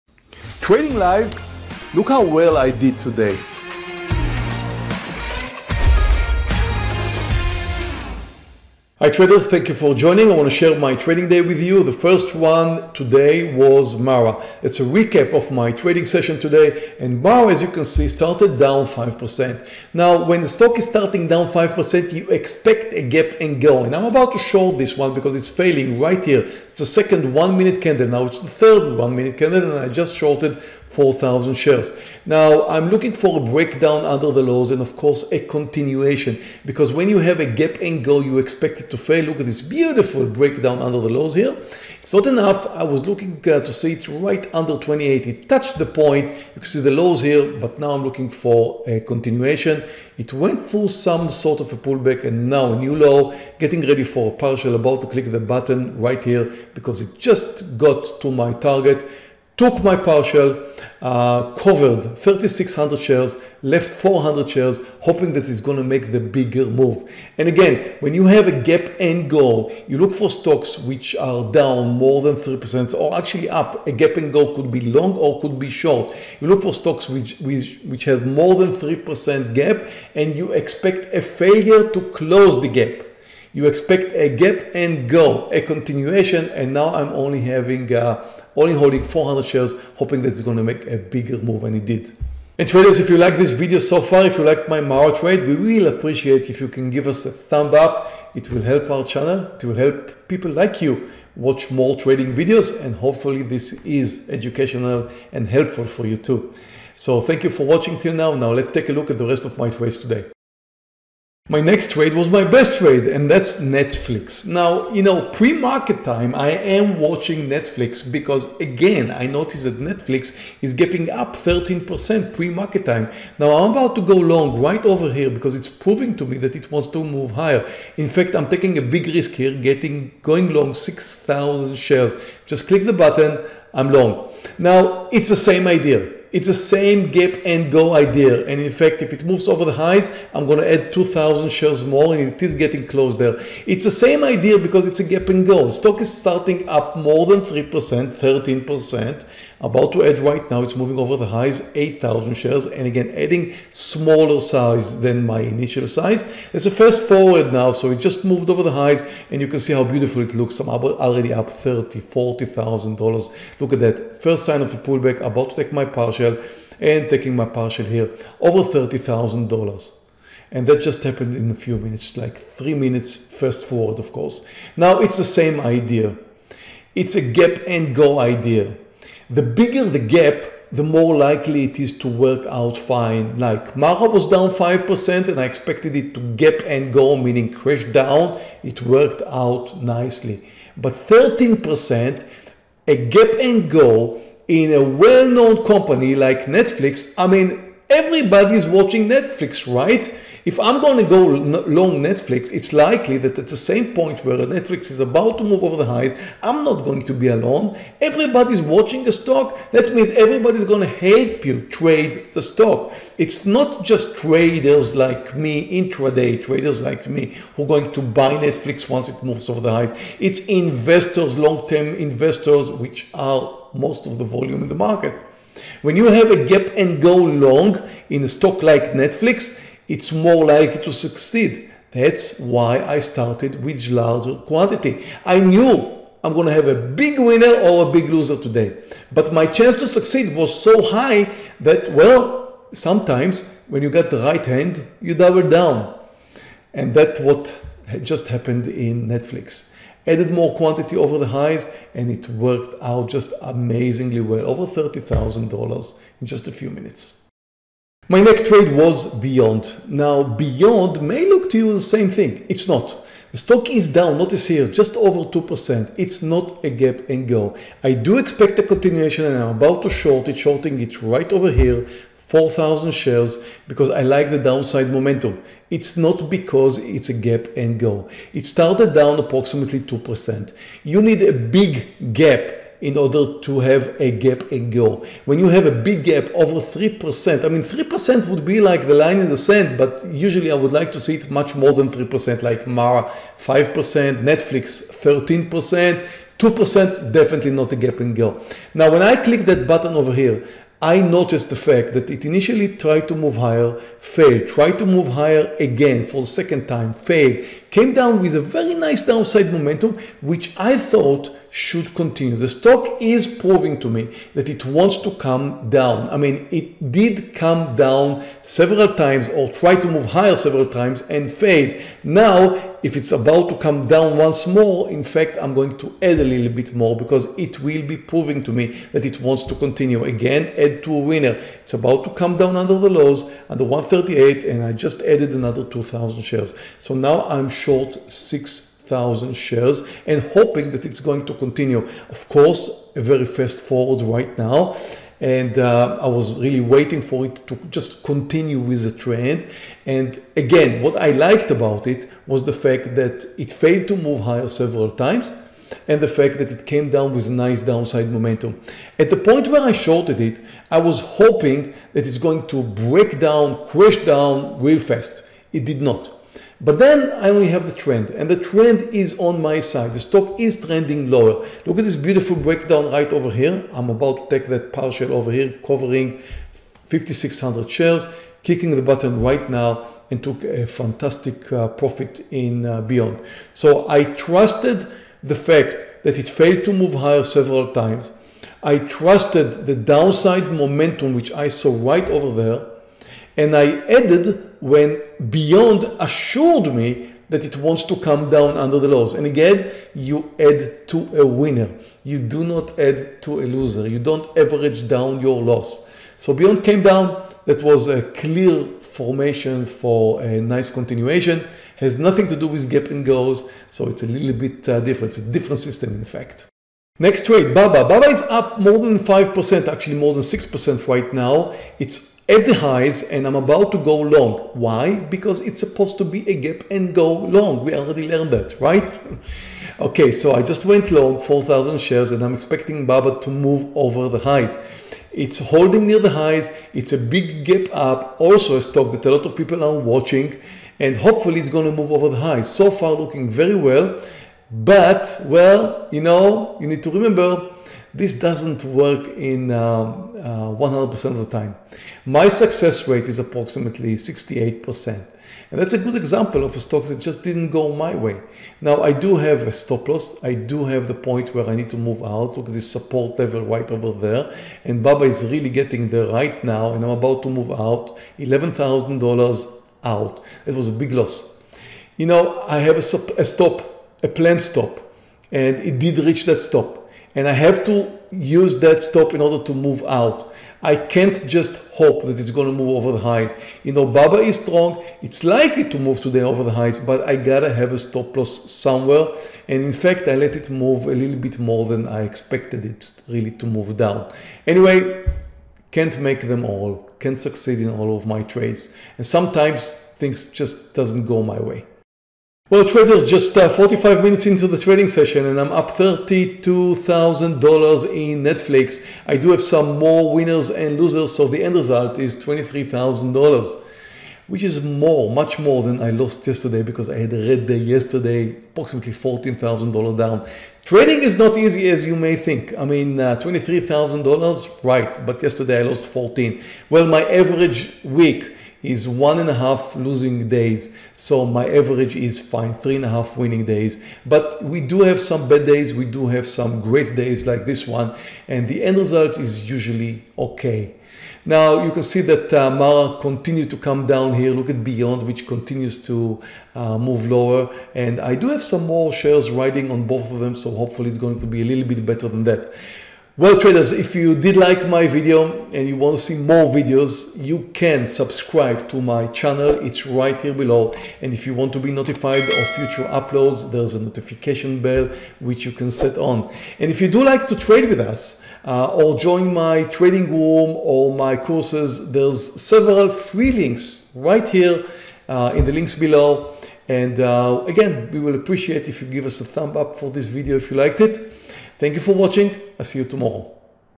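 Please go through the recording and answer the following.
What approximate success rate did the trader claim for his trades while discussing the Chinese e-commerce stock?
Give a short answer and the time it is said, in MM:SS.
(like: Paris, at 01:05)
68%, at 07:33.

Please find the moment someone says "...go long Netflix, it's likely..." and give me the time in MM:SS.
03:21.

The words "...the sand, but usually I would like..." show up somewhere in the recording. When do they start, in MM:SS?
04:49.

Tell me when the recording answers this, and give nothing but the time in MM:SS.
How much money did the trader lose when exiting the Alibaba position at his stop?
07:48.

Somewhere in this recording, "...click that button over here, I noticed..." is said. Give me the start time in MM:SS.
04:59.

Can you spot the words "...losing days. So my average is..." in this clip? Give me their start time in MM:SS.
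08:49.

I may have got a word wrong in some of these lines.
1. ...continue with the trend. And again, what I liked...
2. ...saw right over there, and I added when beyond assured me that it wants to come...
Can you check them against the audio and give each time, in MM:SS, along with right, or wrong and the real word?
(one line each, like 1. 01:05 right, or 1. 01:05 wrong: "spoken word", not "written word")
1. 05:48 right
2. 06:31 right.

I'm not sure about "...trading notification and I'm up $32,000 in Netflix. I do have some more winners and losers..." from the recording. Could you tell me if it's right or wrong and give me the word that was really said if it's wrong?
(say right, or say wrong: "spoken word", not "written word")
wrong: "session", not "notification".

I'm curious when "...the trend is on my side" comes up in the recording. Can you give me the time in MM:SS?
06:08.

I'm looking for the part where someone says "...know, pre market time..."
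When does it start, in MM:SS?
01:55.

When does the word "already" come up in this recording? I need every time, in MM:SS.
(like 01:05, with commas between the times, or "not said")
02:40, 07:07.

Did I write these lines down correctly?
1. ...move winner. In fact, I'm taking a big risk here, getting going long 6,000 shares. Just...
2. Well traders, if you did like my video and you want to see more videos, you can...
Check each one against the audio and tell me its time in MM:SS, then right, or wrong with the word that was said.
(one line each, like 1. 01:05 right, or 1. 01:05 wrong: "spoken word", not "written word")
1. 02:07 wrong: "higher", not "winner"
2. 09:13 right.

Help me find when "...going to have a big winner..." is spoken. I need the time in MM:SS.
03:56.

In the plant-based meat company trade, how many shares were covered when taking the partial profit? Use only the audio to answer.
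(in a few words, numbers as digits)
5,600.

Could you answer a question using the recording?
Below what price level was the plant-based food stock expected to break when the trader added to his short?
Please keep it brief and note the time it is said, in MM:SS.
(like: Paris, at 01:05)
138, at 05:33.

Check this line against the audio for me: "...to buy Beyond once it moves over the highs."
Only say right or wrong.
wrong.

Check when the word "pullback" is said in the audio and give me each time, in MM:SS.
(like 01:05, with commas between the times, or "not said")
00:51, 02:44.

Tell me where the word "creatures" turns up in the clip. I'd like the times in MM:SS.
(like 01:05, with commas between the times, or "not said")
not said.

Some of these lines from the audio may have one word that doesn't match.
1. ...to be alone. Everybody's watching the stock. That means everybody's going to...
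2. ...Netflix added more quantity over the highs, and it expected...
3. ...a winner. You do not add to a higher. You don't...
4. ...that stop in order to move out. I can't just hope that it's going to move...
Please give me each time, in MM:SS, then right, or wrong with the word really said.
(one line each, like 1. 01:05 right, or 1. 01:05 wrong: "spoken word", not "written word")
1. 03:27 right
2. 04:09 wrong: "worked", not "expected"
3. 06:41 wrong: "loser", not "higher"
4. 07:58 right.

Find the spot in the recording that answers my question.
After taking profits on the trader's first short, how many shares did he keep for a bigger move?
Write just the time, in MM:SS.
01:03.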